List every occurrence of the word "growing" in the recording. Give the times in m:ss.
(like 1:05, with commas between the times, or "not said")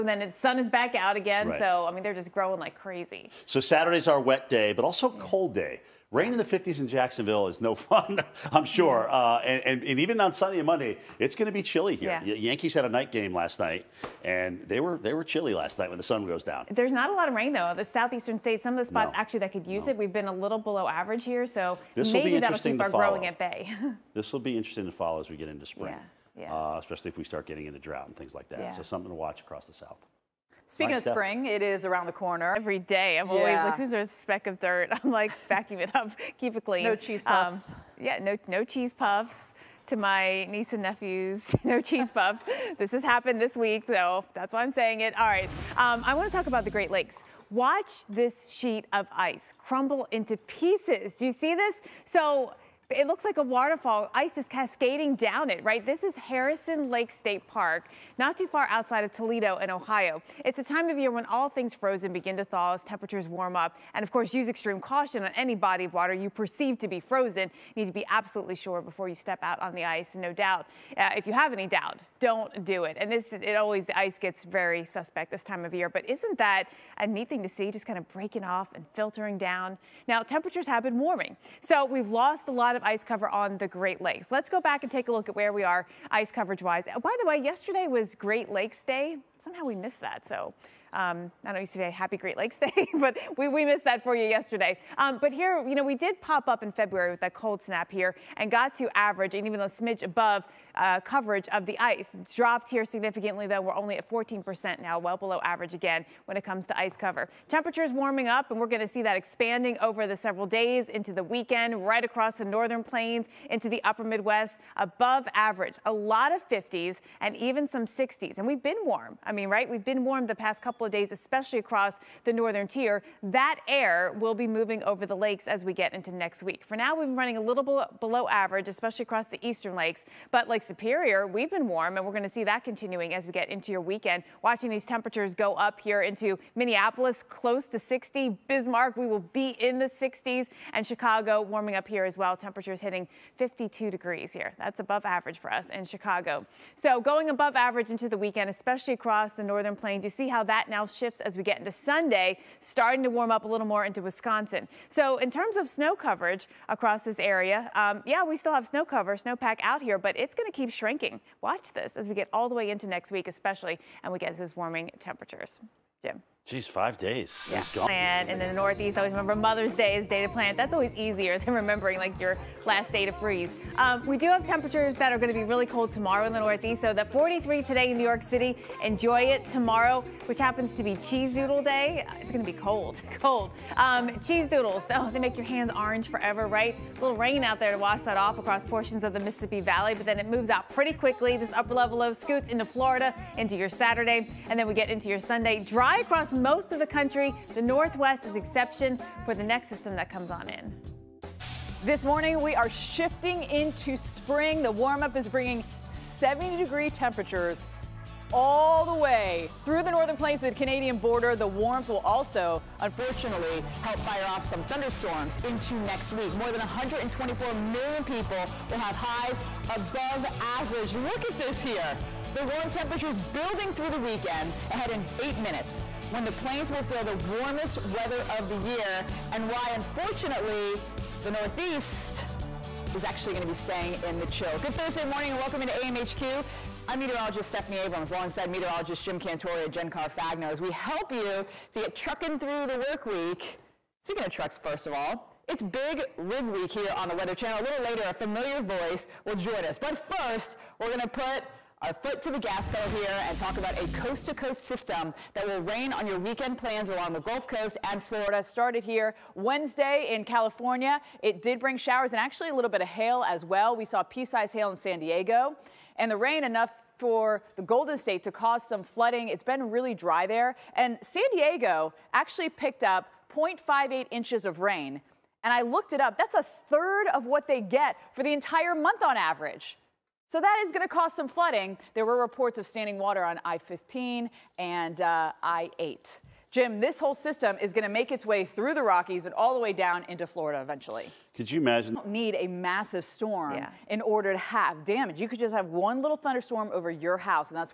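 0:02, 0:22.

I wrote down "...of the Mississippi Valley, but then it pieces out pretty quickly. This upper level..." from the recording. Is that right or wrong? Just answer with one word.
wrong.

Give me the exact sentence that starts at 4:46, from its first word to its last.
Jim, this whole system is going to make its way through the Rockies and all the way down into Florida eventually.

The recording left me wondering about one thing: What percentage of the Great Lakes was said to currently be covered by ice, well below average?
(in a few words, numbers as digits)
14%.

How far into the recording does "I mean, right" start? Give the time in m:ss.
1:59.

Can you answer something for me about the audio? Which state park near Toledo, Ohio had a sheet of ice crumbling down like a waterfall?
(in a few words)
Harrison Lake State Park.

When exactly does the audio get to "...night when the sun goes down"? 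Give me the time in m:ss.
0:15.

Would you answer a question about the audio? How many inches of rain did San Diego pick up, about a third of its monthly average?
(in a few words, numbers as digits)
0.58 inches.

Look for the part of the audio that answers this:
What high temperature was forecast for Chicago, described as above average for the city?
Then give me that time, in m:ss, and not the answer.
2:23.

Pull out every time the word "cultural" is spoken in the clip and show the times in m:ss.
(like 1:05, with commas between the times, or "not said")
not said.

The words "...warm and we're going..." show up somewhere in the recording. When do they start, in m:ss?
2:11.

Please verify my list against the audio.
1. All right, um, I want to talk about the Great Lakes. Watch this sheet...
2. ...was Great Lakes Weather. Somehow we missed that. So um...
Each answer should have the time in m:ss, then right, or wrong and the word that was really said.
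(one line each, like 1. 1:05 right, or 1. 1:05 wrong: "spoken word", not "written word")
1. 0:45 right
2. 1:27 wrong: "Day", not "Weather".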